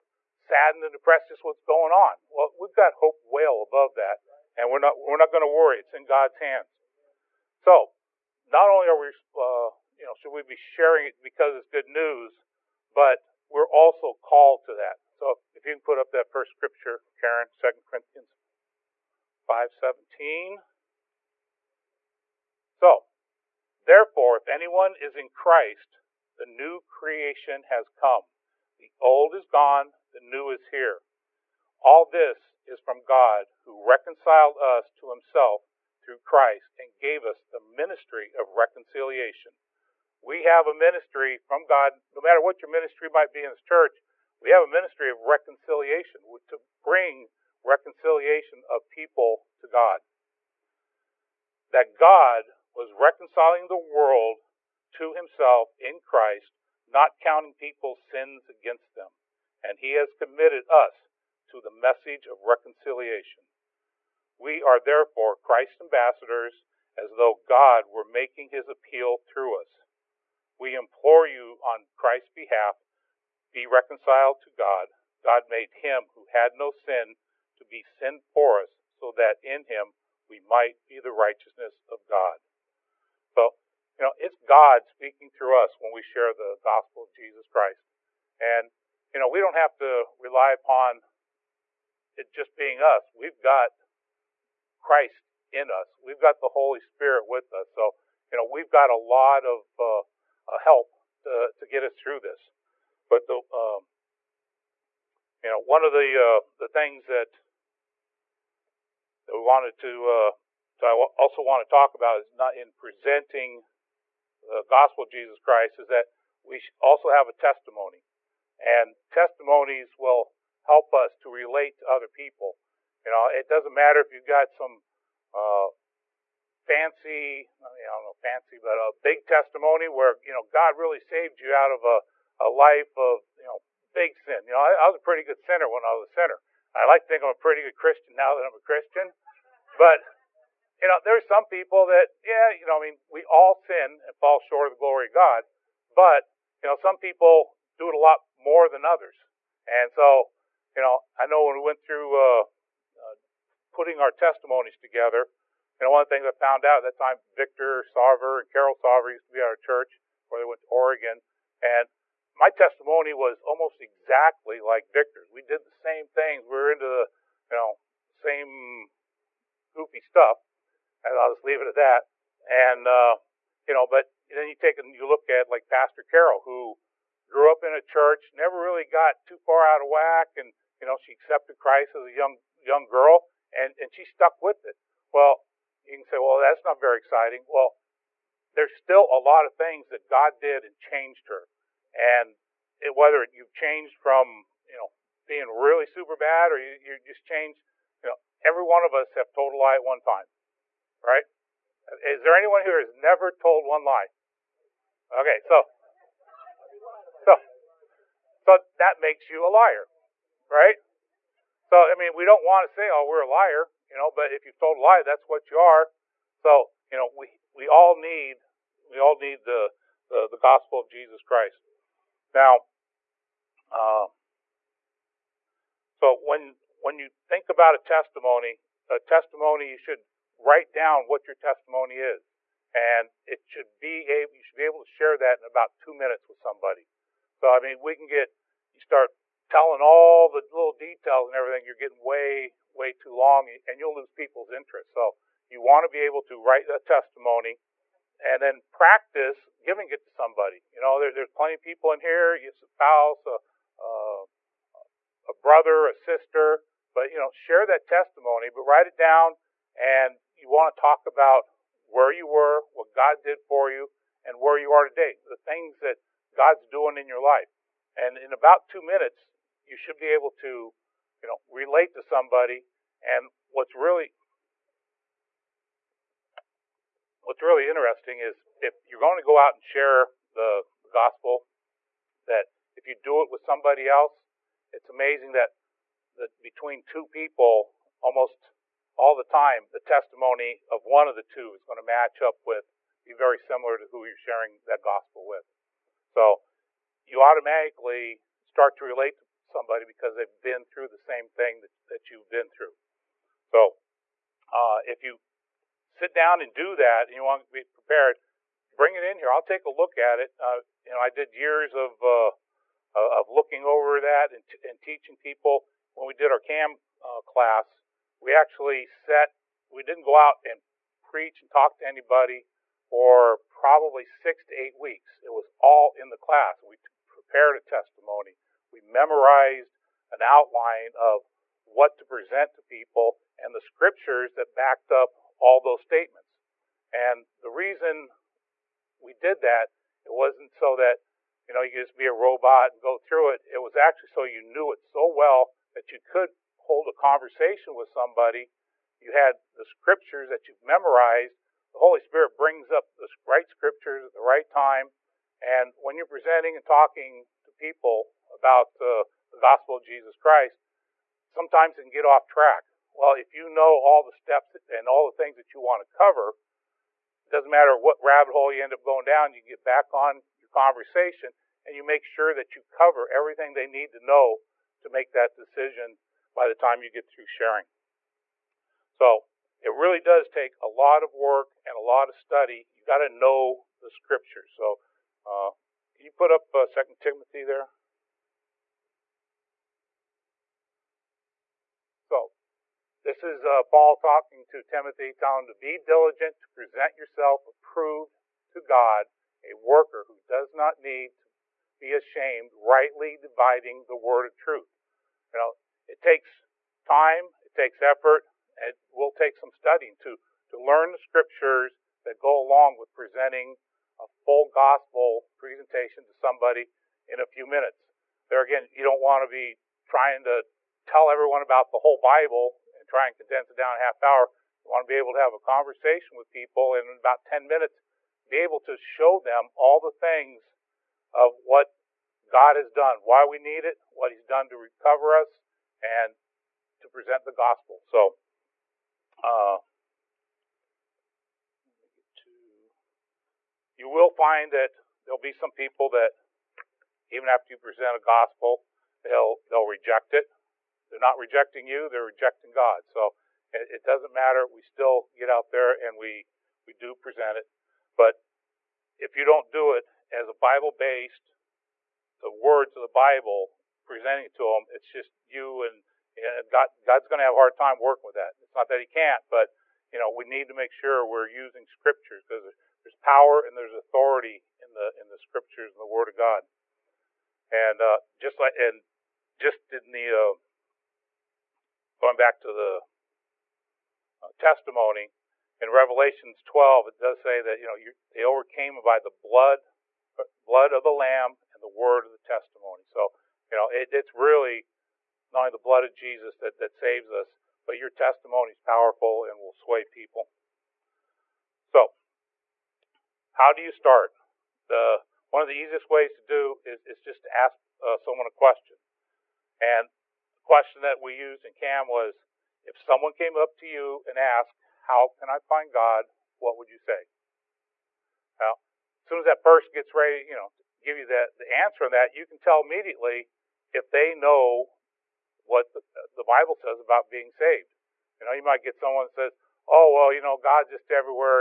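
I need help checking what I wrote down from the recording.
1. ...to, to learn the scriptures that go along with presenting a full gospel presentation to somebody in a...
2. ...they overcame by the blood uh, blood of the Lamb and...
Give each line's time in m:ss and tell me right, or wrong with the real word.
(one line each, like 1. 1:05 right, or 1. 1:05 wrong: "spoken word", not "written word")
1. 6:49 right
2. 8:08 right.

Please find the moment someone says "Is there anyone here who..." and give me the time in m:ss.
3:22.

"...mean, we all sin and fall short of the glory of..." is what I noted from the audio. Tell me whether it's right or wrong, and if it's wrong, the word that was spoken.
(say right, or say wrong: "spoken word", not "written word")
right.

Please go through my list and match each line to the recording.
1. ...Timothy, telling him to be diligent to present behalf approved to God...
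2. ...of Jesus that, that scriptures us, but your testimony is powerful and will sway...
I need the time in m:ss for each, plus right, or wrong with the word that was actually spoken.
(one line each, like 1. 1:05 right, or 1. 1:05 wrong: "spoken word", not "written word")
1. 6:34 wrong: "yourself", not "behalf"
2. 8:15 wrong: "saves", not "scriptures".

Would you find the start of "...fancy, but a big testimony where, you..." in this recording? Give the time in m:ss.
2:08.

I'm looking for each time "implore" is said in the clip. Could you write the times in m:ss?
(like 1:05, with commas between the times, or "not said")
1:10.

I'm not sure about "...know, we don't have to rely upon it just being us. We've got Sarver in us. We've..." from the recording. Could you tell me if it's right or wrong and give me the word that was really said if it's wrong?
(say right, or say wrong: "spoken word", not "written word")
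wrong: "Christ", not "Sarver".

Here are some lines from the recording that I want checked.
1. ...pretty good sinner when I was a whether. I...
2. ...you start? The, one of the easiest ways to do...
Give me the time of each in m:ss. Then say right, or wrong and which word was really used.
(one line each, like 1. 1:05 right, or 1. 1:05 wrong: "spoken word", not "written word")
1. 2:15 wrong: "sinner", not "whether"
2. 8:23 right.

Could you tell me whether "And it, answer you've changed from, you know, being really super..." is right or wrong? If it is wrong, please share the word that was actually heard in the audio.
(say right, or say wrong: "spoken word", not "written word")
wrong: "whether", not "answer".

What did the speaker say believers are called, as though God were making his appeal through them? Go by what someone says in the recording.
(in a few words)
Christ's ambassadors.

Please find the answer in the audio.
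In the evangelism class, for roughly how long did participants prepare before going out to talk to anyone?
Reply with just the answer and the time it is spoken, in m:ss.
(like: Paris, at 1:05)
6 to 8 weeks, at 5:24.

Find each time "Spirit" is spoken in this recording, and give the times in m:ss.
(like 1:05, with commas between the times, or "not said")
1:36, 5:52.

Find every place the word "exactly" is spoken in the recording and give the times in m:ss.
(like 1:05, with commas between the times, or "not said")
2:43.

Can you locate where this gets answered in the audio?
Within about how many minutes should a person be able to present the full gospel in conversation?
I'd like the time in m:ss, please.
7:07.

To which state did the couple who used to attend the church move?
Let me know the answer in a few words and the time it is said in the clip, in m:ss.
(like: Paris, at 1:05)
Oregon, at 2:40.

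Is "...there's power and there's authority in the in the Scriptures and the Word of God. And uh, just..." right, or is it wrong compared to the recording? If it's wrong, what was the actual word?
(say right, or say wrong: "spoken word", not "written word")
right.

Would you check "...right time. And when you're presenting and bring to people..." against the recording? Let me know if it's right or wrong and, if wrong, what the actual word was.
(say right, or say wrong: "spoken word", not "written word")
wrong: "talking", not "bring".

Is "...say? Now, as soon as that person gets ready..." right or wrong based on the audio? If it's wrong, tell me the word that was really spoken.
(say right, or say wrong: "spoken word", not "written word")
right.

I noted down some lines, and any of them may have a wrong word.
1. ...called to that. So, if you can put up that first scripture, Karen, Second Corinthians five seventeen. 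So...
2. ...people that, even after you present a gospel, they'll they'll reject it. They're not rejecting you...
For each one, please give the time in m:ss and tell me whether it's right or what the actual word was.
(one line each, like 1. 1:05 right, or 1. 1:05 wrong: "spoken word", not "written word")
1. 0:14 right
2. 7:25 right.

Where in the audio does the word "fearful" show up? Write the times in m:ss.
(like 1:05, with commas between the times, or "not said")
not said.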